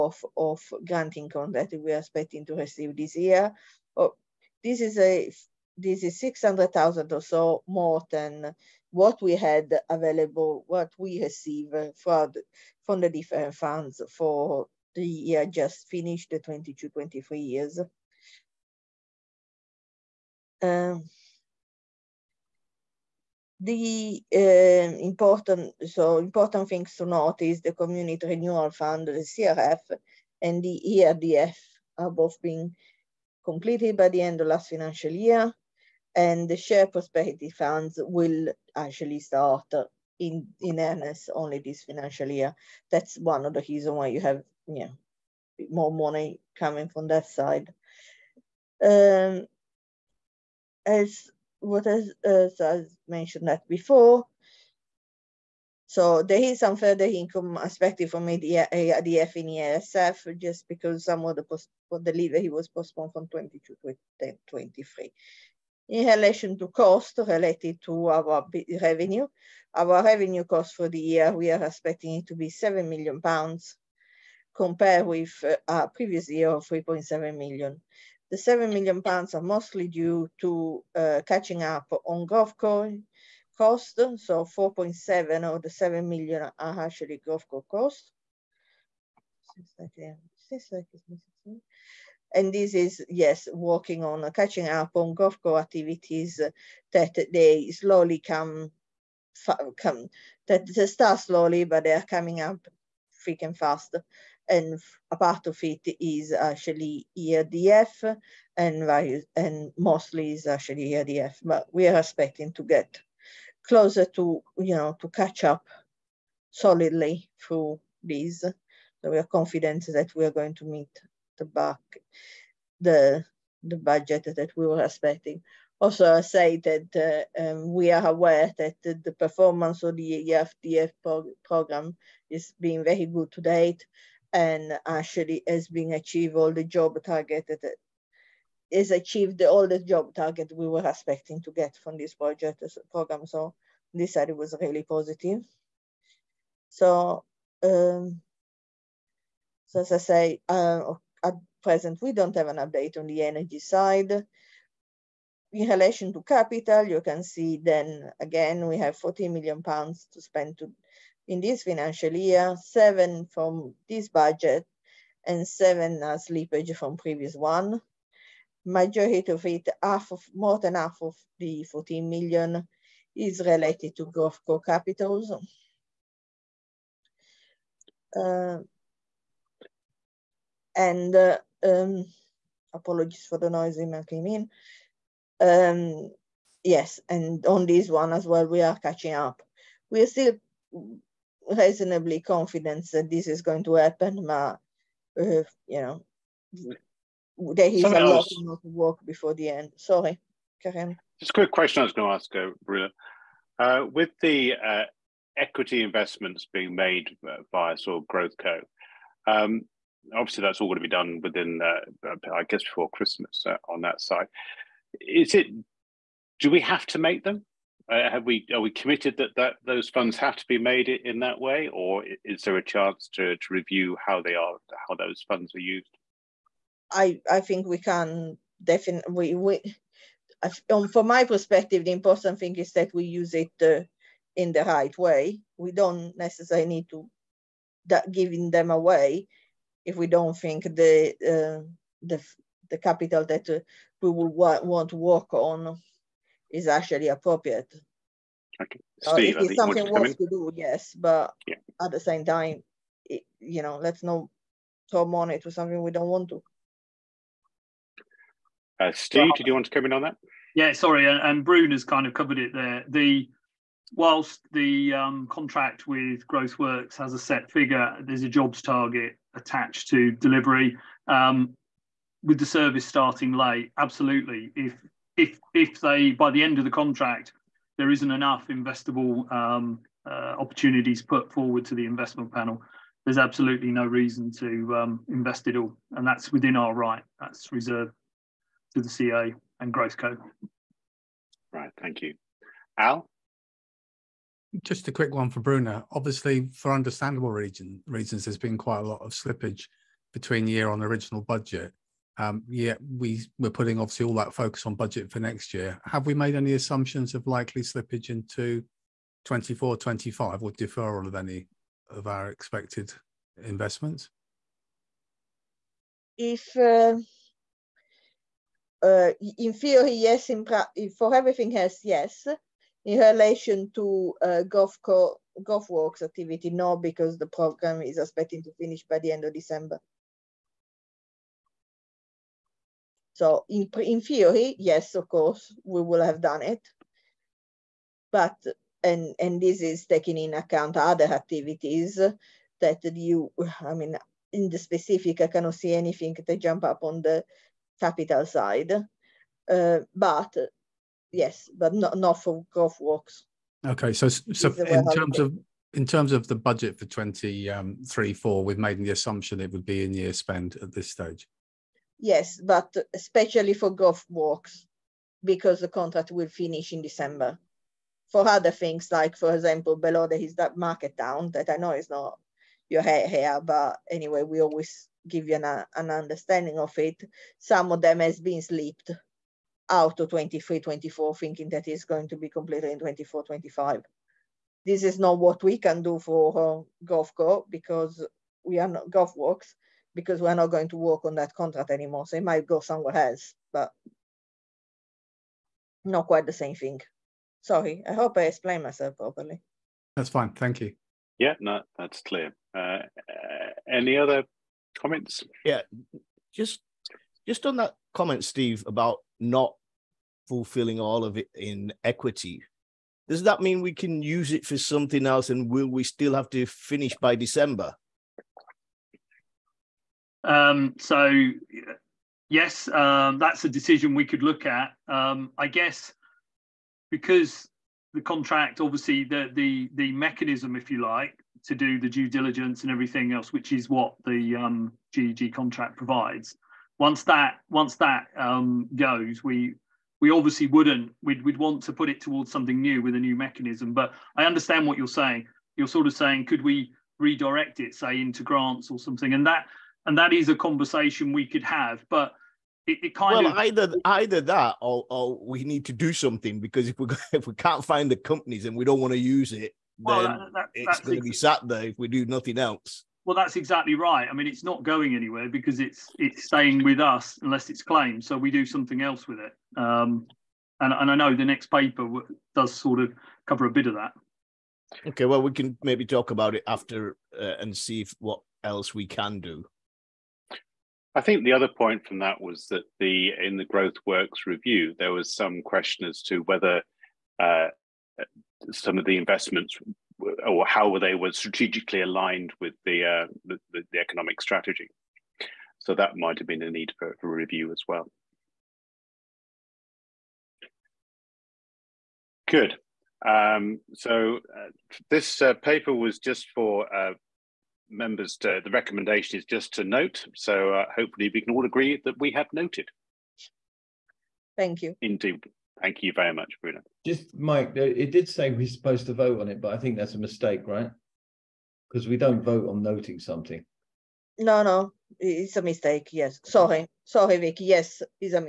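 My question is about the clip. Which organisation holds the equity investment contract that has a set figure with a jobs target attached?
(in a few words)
GrowthWorks.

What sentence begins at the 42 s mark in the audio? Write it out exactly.
That's one of the reasons why you have you know, more money coming from that side.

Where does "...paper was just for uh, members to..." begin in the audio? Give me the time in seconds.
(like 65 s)
505 s.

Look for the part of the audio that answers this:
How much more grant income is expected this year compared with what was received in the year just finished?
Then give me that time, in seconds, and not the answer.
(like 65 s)
6 s.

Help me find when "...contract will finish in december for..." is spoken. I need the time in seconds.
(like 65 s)
365 s.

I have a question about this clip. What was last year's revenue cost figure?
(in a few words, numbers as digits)
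3.7 million.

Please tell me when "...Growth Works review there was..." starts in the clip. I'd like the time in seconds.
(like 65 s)
483 s.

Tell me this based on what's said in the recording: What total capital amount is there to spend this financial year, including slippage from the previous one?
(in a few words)
14 million pounds.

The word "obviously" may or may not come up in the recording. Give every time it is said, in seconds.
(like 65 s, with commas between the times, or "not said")
210 s, 295 s, 303 s, 428 s, 440 s.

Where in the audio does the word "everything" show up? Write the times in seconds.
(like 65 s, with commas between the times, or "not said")
321 s, 432 s.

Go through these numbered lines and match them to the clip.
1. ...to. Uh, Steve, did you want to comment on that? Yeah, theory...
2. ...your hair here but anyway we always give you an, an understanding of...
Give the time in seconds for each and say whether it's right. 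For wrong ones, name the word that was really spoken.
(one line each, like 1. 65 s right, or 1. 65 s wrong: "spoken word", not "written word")
1. 256 s wrong: "sorry", not "theory"
2. 372 s right.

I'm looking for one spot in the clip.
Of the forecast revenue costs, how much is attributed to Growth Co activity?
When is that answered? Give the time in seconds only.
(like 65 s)
84 s.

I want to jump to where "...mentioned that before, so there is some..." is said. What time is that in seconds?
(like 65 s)
53 s.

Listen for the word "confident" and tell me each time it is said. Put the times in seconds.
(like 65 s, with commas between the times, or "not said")
119 s, 192 s.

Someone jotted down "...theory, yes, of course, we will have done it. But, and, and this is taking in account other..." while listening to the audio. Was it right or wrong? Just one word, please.
right.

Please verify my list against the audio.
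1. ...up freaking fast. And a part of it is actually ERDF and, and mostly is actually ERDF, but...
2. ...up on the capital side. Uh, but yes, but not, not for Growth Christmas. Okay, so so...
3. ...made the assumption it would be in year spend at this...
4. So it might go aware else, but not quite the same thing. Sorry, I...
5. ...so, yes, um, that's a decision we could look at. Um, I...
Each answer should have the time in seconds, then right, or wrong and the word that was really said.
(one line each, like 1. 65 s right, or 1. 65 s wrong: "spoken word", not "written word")
1. 102 s right
2. 346 s wrong: "Works", not "Christmas"
3. 358 s right
4. 392 s wrong: "somewhere", not "aware"
5. 420 s right.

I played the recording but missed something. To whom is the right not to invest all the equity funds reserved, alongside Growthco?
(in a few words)
the CEO.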